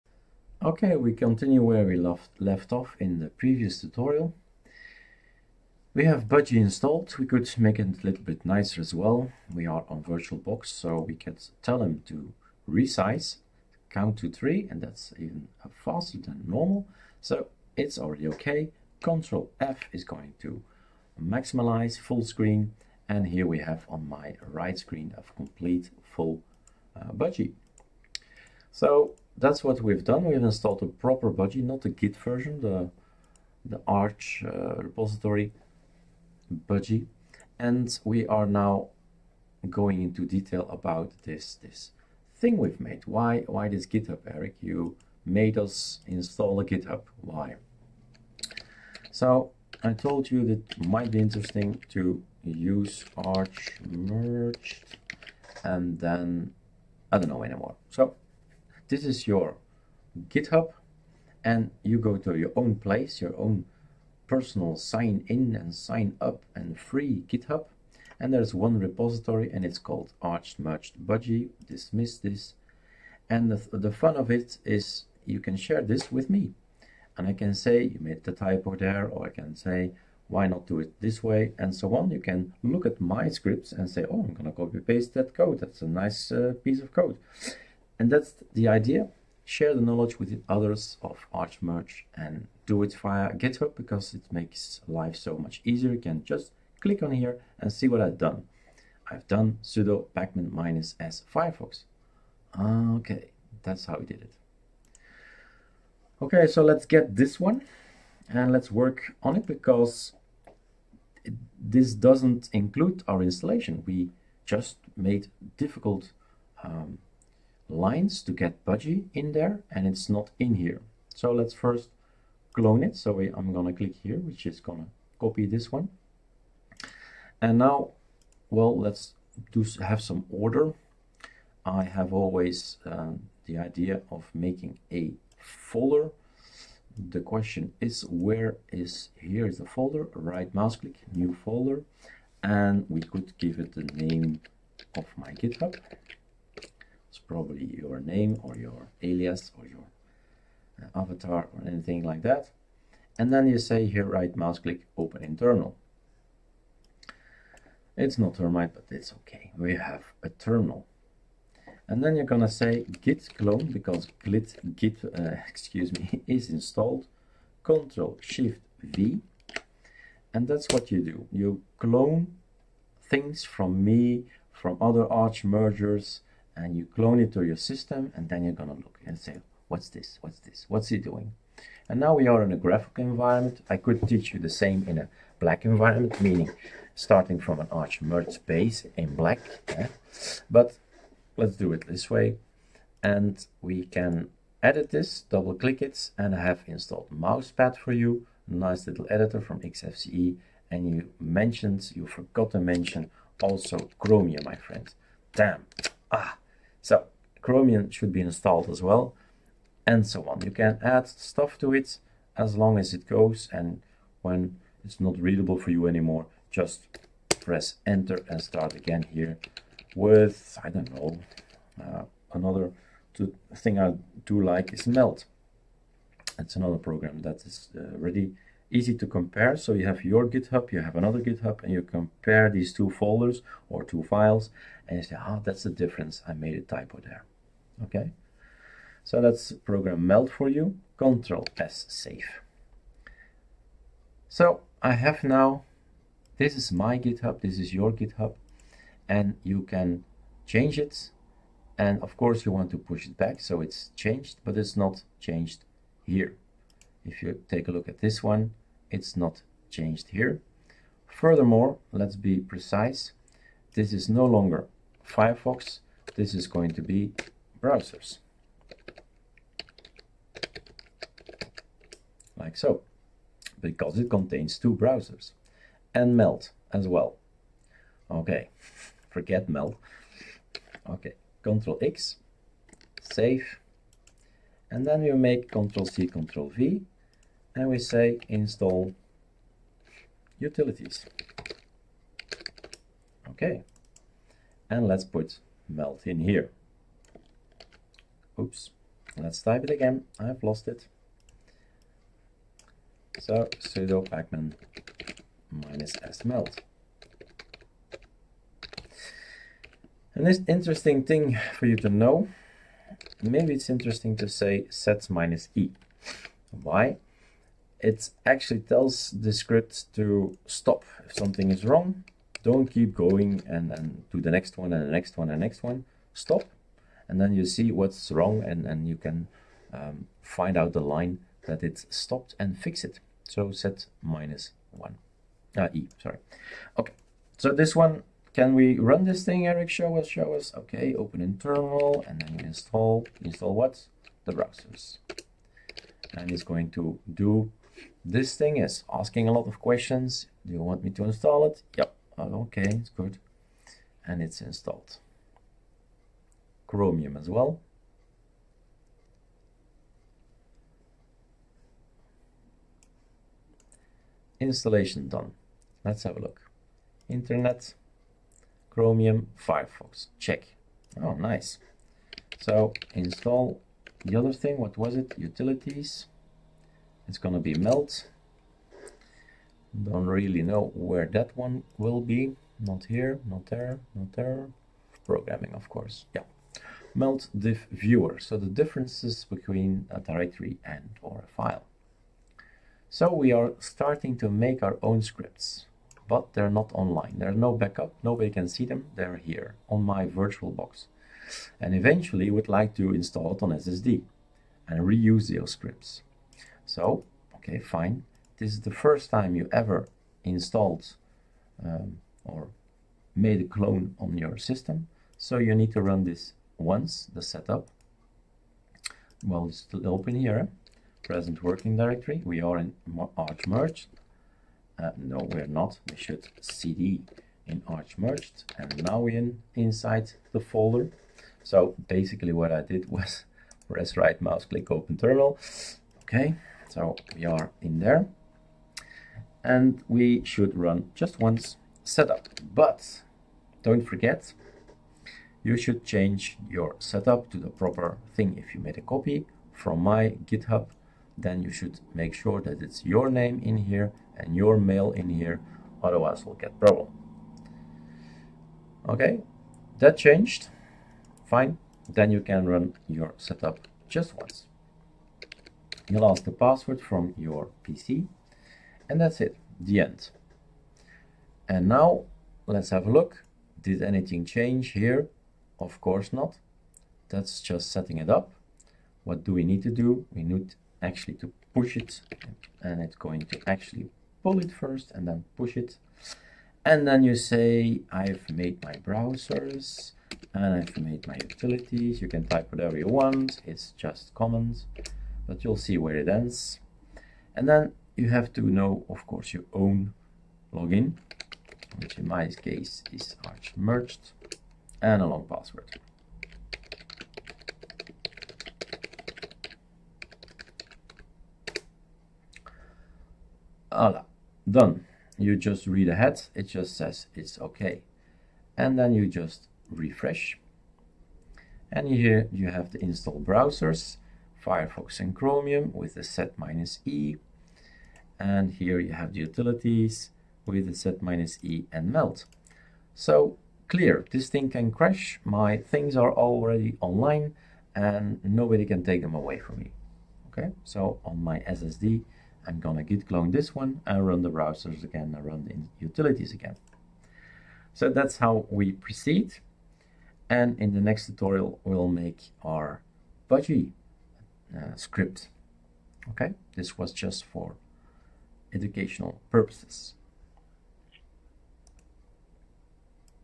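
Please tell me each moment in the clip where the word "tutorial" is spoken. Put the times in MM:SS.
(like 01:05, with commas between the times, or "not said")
00:03, 09:11.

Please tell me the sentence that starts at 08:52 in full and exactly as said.
So clear, this thing can crash.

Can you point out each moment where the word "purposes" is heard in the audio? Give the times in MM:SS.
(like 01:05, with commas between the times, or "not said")
09:19.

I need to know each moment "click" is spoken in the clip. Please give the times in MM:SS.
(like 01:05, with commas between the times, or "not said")
01:36, 02:03, 02:20, 02:34, 03:15, 07:14.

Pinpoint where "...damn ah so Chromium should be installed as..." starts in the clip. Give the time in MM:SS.
03:25.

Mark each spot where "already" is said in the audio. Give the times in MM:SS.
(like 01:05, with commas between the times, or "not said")
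00:17, 08:56.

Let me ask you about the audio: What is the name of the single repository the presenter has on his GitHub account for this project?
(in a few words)
Arched Merged Budgie.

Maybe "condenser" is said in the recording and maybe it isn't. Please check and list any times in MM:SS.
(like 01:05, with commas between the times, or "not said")
not said.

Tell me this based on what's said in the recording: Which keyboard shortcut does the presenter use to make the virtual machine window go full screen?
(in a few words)
Control F.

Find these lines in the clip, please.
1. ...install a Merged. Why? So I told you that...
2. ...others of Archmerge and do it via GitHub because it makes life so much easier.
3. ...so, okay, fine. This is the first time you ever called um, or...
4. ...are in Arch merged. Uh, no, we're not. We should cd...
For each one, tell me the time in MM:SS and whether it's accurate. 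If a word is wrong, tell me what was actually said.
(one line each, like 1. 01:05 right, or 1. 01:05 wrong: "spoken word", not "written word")
1. 00:46 wrong: "GitHub", not "Merged"
2. 01:30 right
3. 06:46 wrong: "installed", not "called"
4. 07:02 right.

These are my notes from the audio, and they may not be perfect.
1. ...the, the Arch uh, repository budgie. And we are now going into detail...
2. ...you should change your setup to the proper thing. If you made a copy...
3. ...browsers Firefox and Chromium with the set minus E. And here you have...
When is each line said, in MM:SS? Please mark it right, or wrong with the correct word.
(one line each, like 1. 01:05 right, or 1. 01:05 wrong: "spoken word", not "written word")
1. 00:32 right
2. 07:25 right
3. 08:43 right.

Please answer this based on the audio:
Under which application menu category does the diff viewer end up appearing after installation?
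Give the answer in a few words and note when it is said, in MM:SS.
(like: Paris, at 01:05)
programming, at 06:25.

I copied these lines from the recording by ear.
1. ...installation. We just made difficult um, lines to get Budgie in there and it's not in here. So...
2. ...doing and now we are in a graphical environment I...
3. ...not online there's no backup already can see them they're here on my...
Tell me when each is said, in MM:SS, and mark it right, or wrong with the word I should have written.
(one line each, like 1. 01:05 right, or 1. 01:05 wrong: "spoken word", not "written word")
1. 01:53 right
2. 03:01 right
3. 06:36 wrong: "nobody", not "already".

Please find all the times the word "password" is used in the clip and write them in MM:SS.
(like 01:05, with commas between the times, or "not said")
07:46, 08:25.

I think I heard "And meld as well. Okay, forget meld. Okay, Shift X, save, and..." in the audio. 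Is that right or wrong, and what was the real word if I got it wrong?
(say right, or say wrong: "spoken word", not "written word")
wrong: "Control", not "Shift".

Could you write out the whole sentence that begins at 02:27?
It's probably your name or your alias or your uh, avatar or anything like that.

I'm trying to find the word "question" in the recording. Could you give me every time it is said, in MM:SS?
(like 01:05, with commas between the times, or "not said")
02:17, 05:49.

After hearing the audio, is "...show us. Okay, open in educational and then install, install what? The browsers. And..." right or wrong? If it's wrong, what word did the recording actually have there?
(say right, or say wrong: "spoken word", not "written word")
wrong: "terminal", not "educational".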